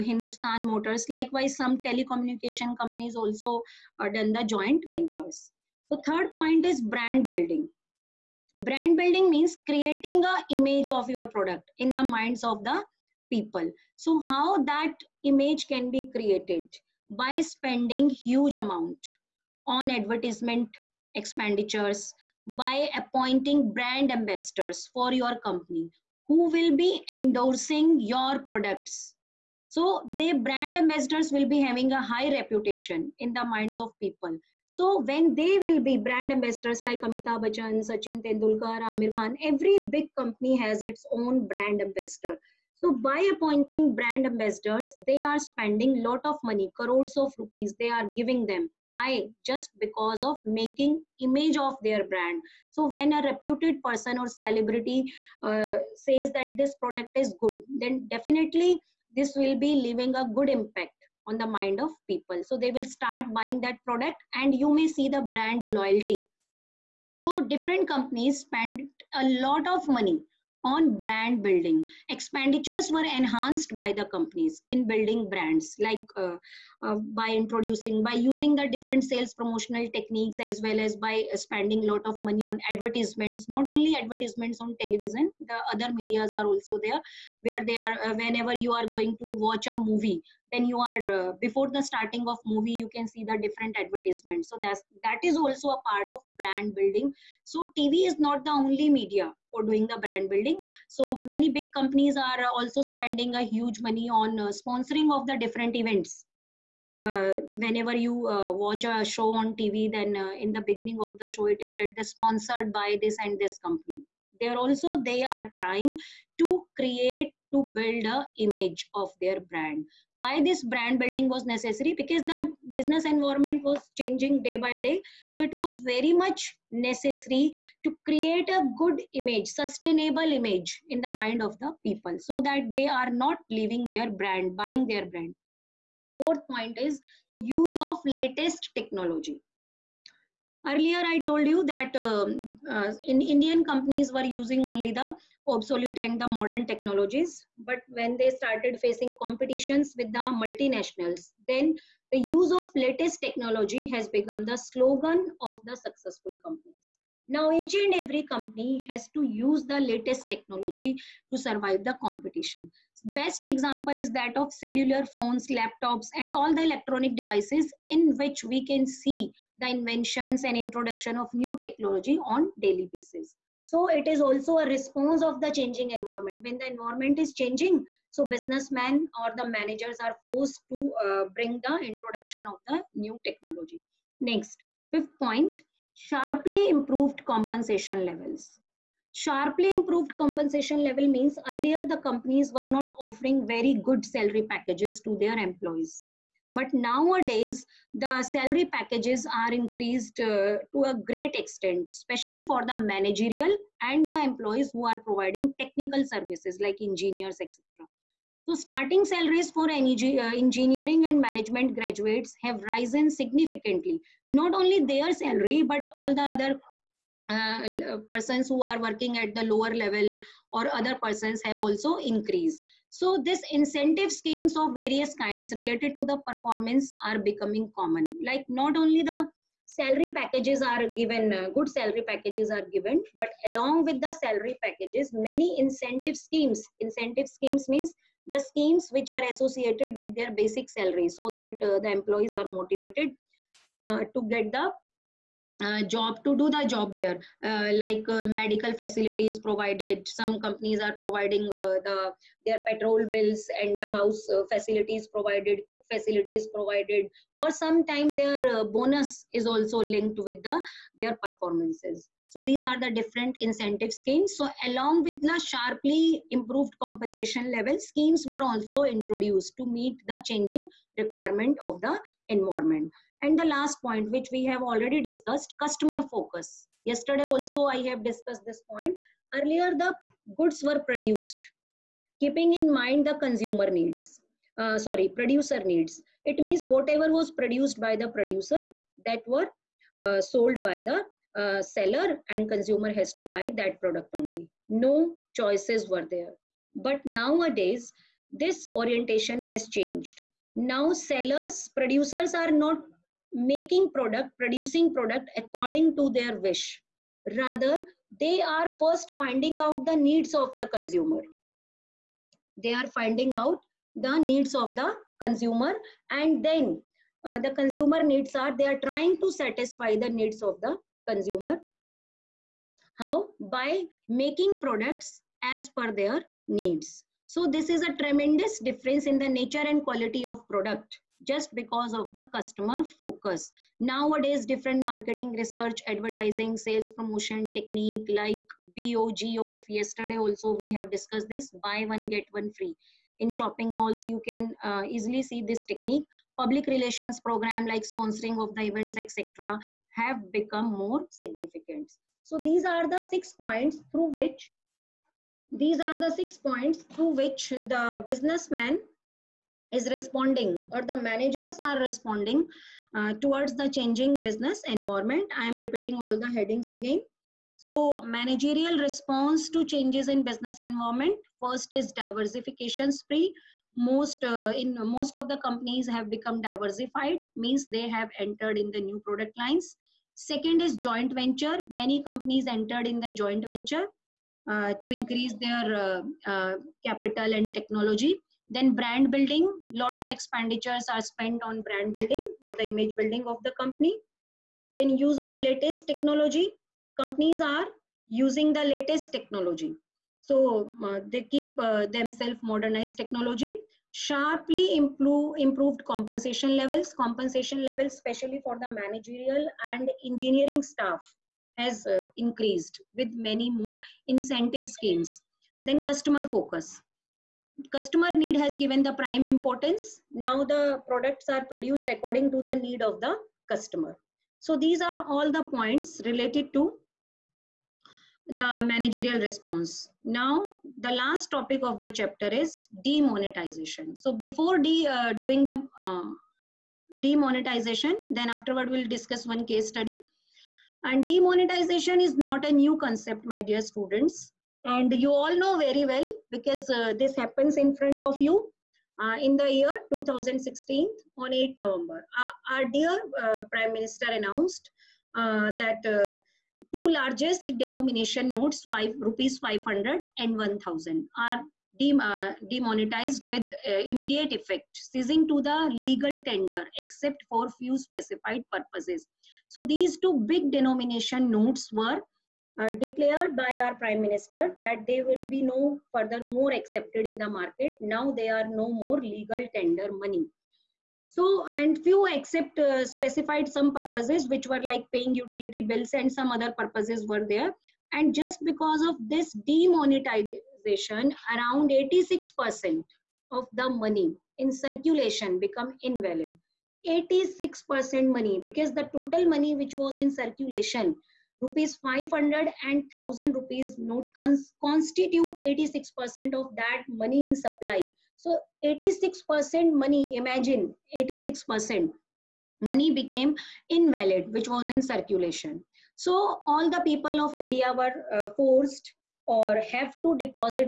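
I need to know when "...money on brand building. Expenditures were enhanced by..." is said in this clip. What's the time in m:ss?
1:09.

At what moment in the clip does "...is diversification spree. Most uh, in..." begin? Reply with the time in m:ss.
6:11.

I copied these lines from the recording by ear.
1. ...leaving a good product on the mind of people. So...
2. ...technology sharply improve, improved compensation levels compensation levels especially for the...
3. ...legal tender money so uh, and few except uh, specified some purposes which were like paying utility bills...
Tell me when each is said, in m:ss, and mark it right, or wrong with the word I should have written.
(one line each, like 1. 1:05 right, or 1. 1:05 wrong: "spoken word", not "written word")
1. 0:59 wrong: "impact", not "product"
2. 6:42 right
3. 7:59 right.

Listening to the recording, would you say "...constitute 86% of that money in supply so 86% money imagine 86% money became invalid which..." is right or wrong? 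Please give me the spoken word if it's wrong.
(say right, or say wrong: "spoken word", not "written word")
right.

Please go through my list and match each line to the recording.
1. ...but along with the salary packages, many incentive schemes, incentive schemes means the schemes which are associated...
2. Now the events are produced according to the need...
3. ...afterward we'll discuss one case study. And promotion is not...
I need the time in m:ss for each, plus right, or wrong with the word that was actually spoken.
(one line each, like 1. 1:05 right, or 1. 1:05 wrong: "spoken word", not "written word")
1. 3:53 right
2. 7:00 wrong: "products", not "events"
3. 7:18 wrong: "demonetization", not "promotion".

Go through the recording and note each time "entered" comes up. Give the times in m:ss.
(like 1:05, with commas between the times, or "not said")
6:18, 6:22.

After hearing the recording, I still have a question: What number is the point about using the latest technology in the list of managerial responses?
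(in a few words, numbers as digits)
Fourth.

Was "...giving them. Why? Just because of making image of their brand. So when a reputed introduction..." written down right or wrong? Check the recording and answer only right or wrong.
wrong.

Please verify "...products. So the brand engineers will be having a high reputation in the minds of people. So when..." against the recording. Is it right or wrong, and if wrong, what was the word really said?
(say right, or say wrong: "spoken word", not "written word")
wrong: "ambassadors", not "engineers".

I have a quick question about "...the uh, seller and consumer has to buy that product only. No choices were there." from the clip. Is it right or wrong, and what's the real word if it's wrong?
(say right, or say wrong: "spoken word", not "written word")
right.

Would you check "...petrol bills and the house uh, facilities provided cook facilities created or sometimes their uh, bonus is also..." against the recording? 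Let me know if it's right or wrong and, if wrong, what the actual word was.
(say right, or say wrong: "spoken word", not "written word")
wrong: "provided", not "created".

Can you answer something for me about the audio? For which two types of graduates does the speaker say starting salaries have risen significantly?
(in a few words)
Engineering and management.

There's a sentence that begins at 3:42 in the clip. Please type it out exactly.
So this incentive schemes of various kinds related to the performance are becoming common.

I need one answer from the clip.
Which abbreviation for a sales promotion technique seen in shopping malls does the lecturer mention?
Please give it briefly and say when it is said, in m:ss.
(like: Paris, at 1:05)
BOGOF, at 5:38.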